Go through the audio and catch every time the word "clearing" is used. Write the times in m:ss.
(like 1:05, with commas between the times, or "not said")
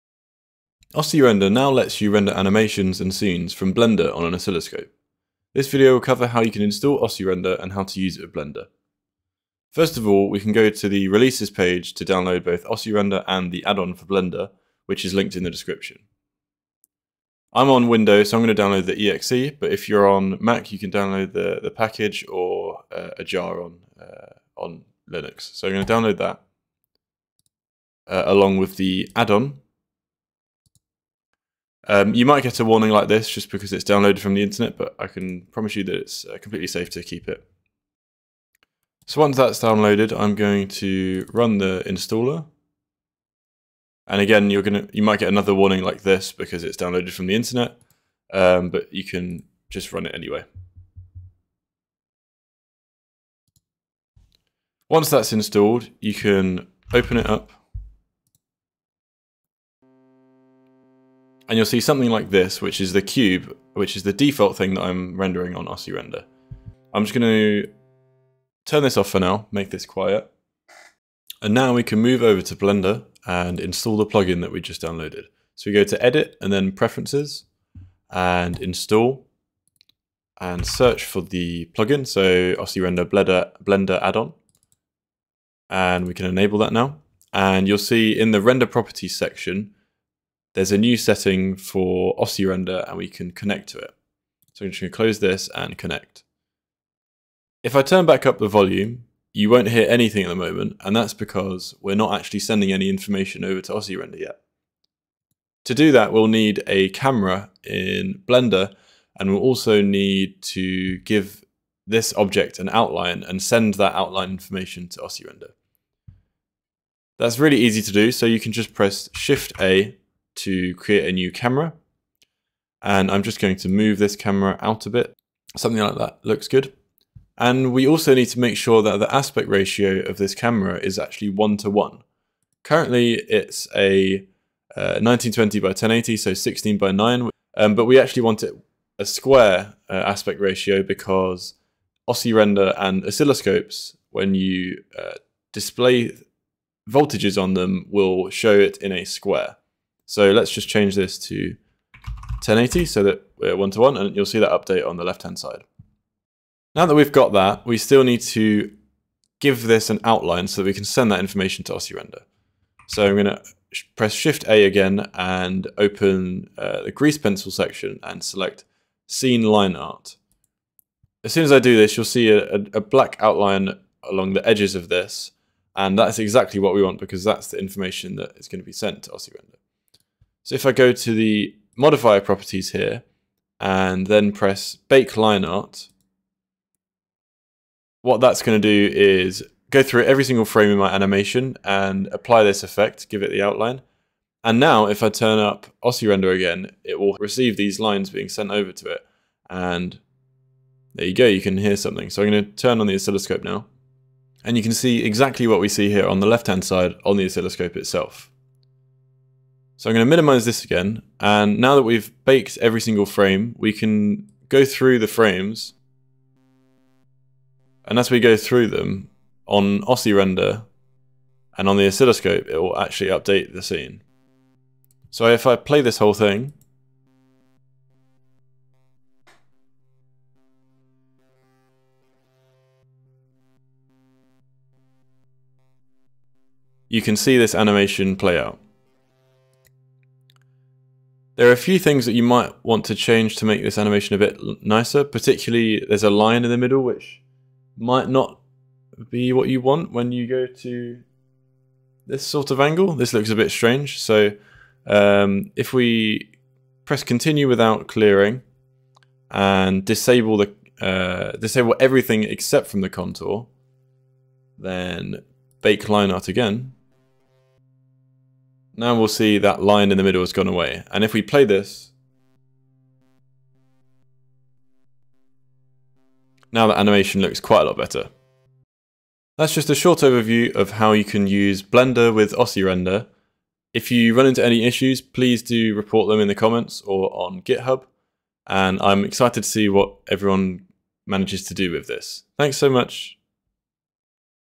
4:17.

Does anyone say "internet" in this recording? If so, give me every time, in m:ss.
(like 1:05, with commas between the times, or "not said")
0:34, 0:47.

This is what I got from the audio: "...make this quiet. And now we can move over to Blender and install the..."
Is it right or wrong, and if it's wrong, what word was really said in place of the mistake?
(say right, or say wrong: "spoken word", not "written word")
right.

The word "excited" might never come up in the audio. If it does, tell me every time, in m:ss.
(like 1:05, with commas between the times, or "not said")
4:49.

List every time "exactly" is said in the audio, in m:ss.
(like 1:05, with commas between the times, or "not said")
2:56, 3:25.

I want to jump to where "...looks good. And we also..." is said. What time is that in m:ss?
2:06.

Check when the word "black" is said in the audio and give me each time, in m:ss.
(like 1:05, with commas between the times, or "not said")
2:52.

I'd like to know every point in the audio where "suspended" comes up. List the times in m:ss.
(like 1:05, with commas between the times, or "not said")
not said.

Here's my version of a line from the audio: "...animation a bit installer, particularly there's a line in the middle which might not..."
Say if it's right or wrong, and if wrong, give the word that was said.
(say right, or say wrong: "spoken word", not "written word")
wrong: "nicer", not "installer".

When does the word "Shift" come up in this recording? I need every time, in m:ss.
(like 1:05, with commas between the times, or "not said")
1:59, 2:44.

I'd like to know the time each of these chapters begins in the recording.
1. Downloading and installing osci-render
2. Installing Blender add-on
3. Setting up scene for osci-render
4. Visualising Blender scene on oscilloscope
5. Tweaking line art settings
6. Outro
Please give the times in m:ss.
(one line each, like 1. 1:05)
1. 0:10
2. 1:11
3. 1:36
4. 3:23
5. 4:00
6. 4:38.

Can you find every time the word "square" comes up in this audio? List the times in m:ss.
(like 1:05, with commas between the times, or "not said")
2:19, 2:29.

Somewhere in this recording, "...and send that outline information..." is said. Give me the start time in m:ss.
1:53.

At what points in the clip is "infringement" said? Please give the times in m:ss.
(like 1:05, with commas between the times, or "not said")
not said.